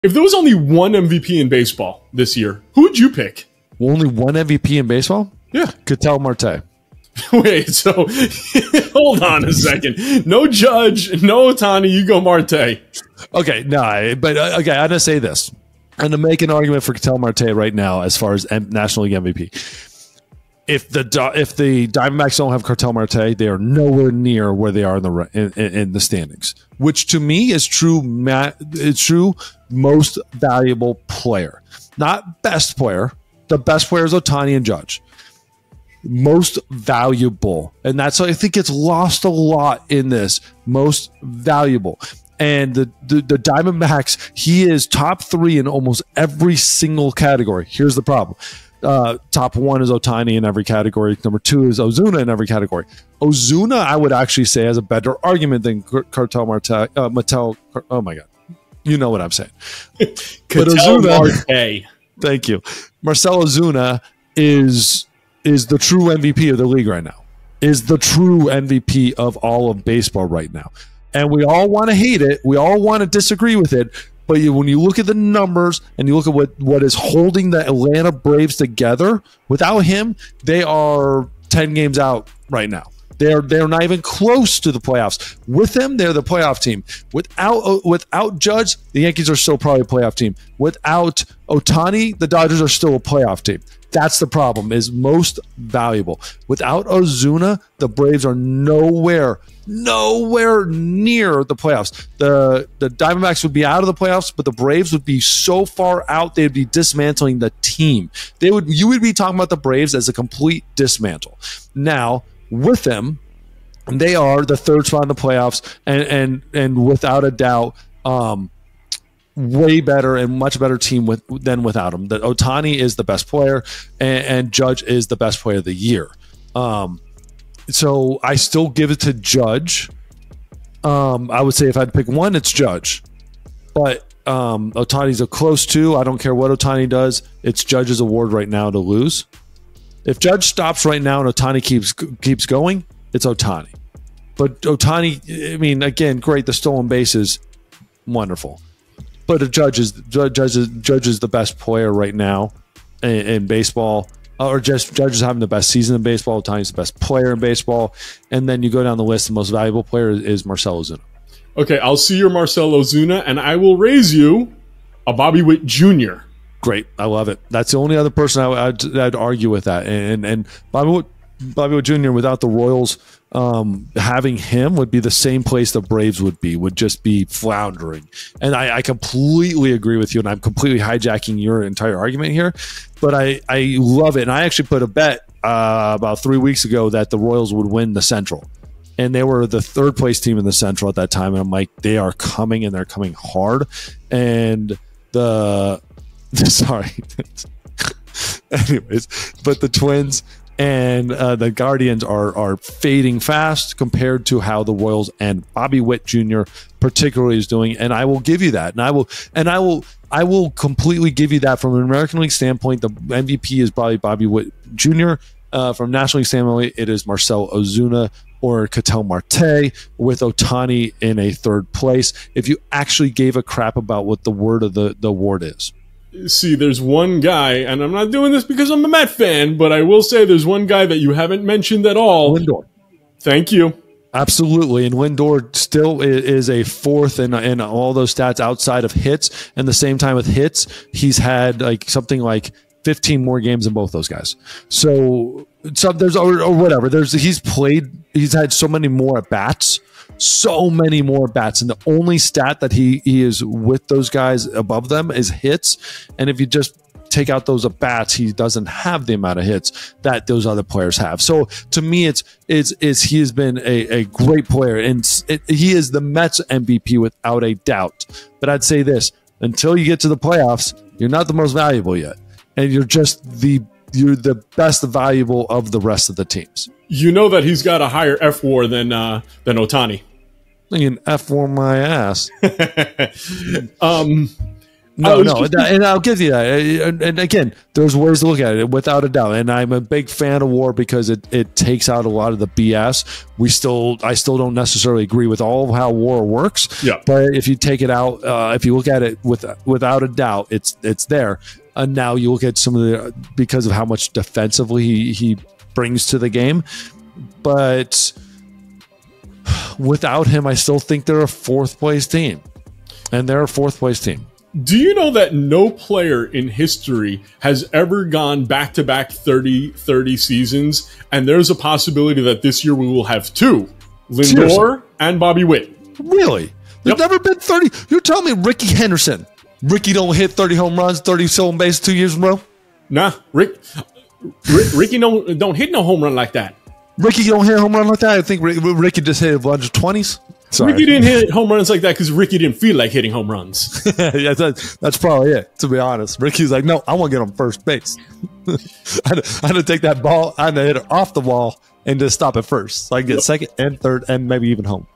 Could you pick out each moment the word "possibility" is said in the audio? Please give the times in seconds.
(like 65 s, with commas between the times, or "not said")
321 s.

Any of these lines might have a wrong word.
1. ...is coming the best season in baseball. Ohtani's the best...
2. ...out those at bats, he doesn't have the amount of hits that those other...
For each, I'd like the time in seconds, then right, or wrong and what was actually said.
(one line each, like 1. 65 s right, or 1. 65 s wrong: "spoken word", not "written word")
1. 155 s wrong: "having", not "coming"
2. 257 s right.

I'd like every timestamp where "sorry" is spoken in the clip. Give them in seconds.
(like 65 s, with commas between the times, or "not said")
196 s, 340 s.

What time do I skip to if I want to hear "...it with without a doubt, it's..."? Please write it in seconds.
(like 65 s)
299 s.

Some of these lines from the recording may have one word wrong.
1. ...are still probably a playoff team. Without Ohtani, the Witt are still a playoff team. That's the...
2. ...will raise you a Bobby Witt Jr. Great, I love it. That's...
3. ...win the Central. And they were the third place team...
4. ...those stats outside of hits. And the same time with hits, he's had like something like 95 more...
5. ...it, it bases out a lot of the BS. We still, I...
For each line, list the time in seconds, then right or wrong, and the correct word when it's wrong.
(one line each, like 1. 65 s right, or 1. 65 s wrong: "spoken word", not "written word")
1. 89 s wrong: "Dodgers", not "Witt"
2. 163 s right
3. 187 s right
4. 237 s wrong: "15", not "95"
5. 291 s wrong: "takes", not "bases".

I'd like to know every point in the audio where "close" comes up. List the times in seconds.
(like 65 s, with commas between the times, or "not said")
84 s, 135 s.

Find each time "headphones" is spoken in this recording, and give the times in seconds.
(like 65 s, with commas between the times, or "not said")
not said.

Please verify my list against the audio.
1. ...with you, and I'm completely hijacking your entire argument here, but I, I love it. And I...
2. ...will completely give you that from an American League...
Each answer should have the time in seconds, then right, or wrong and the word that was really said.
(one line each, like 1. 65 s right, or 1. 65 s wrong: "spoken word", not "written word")
1. 179 s right
2. 210 s right.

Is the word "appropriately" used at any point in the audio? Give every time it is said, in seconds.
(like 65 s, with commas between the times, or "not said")
not said.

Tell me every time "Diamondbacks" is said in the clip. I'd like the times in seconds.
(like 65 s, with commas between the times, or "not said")
21 s, 43 s, 102 s.